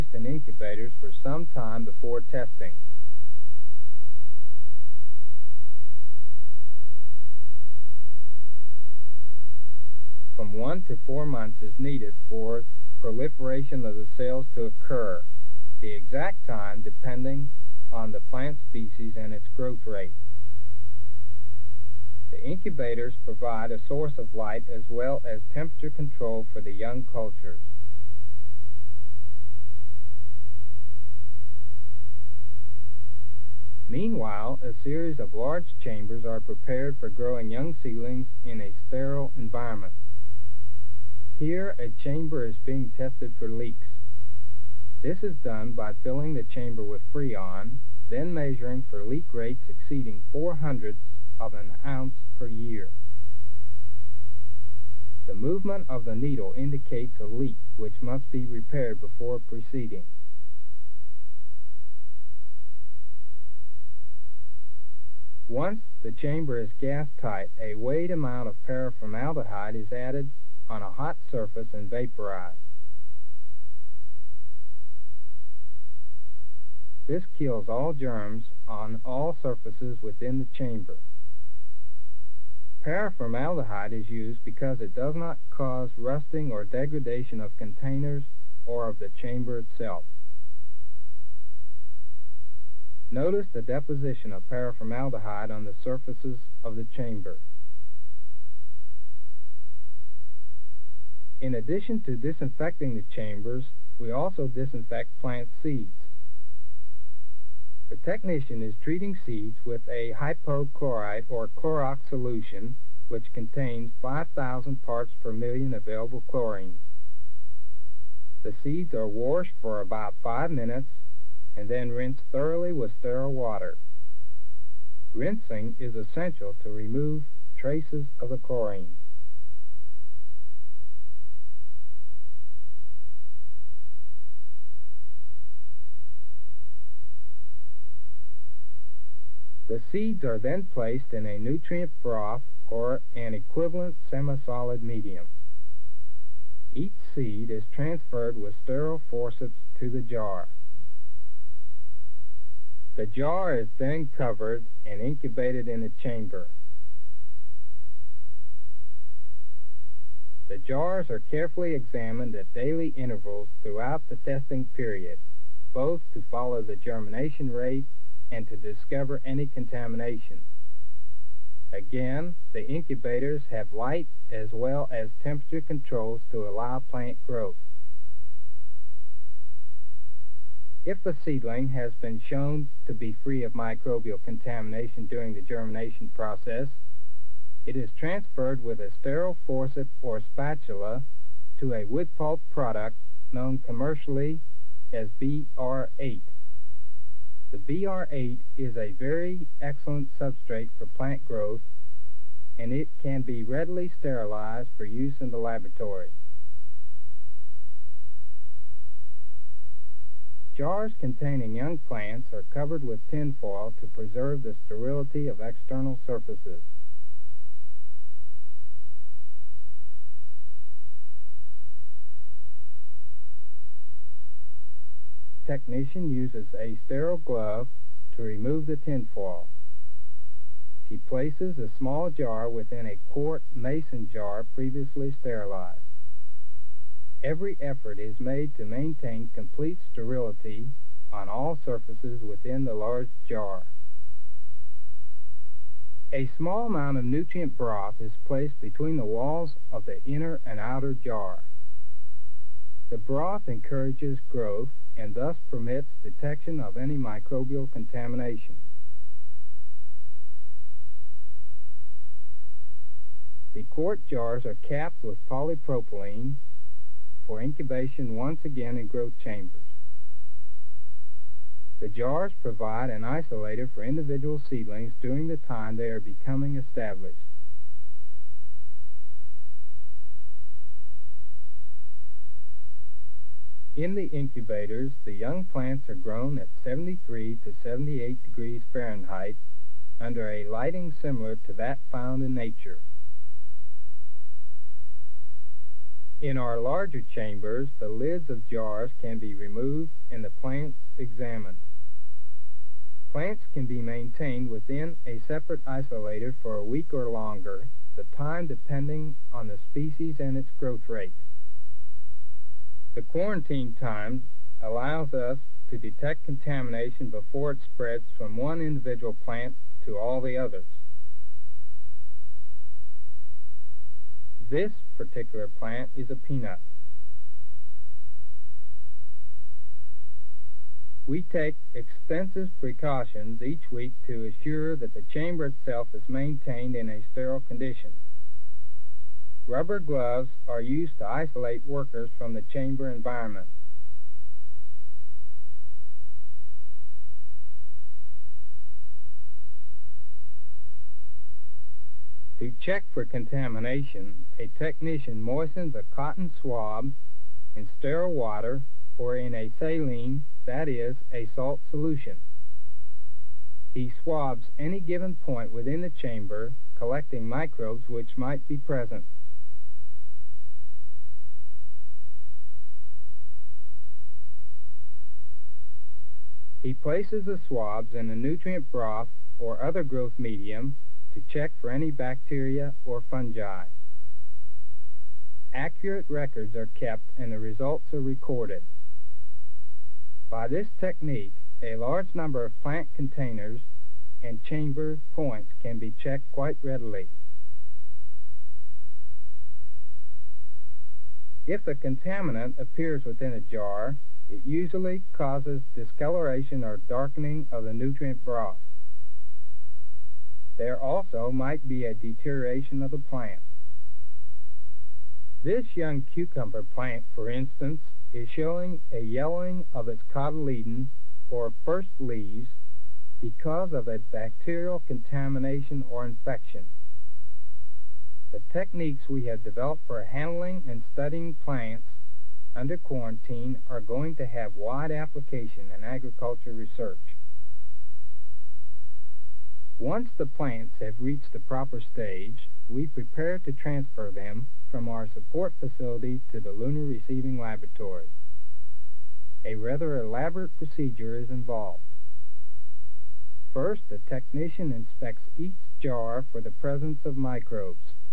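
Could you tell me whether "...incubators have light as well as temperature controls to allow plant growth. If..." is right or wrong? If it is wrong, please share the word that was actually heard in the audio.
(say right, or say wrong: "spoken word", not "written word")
right.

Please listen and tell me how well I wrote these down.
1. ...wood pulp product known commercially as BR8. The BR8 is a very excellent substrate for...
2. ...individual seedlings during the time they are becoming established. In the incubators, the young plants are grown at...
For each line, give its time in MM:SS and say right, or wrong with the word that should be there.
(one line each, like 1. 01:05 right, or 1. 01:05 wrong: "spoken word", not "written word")
1. 03:11 right
2. 04:33 right.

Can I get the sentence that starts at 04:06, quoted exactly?
A small amount of nutrient broth is placed between the walls of the inner and outer jar.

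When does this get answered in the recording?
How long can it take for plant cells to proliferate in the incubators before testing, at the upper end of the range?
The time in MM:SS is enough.
00:11.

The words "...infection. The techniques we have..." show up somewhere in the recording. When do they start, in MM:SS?
07:06.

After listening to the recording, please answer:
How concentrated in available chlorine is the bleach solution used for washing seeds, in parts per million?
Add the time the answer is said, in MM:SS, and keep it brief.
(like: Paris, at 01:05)
5,000, at 01:54.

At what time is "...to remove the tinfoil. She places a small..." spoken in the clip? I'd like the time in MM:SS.
03:48.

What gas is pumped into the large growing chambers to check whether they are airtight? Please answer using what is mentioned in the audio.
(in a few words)
Freon.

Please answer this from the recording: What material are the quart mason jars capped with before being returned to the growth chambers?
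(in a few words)
polypropylene.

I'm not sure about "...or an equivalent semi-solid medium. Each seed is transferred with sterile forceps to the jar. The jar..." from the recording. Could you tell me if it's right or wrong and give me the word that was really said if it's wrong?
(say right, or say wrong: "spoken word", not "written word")
right.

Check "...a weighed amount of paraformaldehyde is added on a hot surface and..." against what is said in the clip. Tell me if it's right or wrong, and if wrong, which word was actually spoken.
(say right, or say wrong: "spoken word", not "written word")
right.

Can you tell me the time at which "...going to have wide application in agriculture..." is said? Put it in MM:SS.
07:13.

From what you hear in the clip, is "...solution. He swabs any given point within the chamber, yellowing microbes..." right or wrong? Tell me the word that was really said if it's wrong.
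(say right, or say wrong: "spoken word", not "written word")
wrong: "collecting", not "yellowing".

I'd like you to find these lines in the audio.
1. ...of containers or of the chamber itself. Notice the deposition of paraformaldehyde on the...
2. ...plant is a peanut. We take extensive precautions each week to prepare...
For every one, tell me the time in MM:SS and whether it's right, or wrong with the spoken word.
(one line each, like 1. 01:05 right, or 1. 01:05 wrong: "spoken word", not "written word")
1. 01:27 right
2. 05:25 wrong: "assure", not "prepare".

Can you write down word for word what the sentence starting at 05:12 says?
The quarantine time allows us to detect contamination before it spreads from one individual plant to all the others.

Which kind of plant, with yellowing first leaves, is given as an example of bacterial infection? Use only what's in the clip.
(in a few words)
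cucumber.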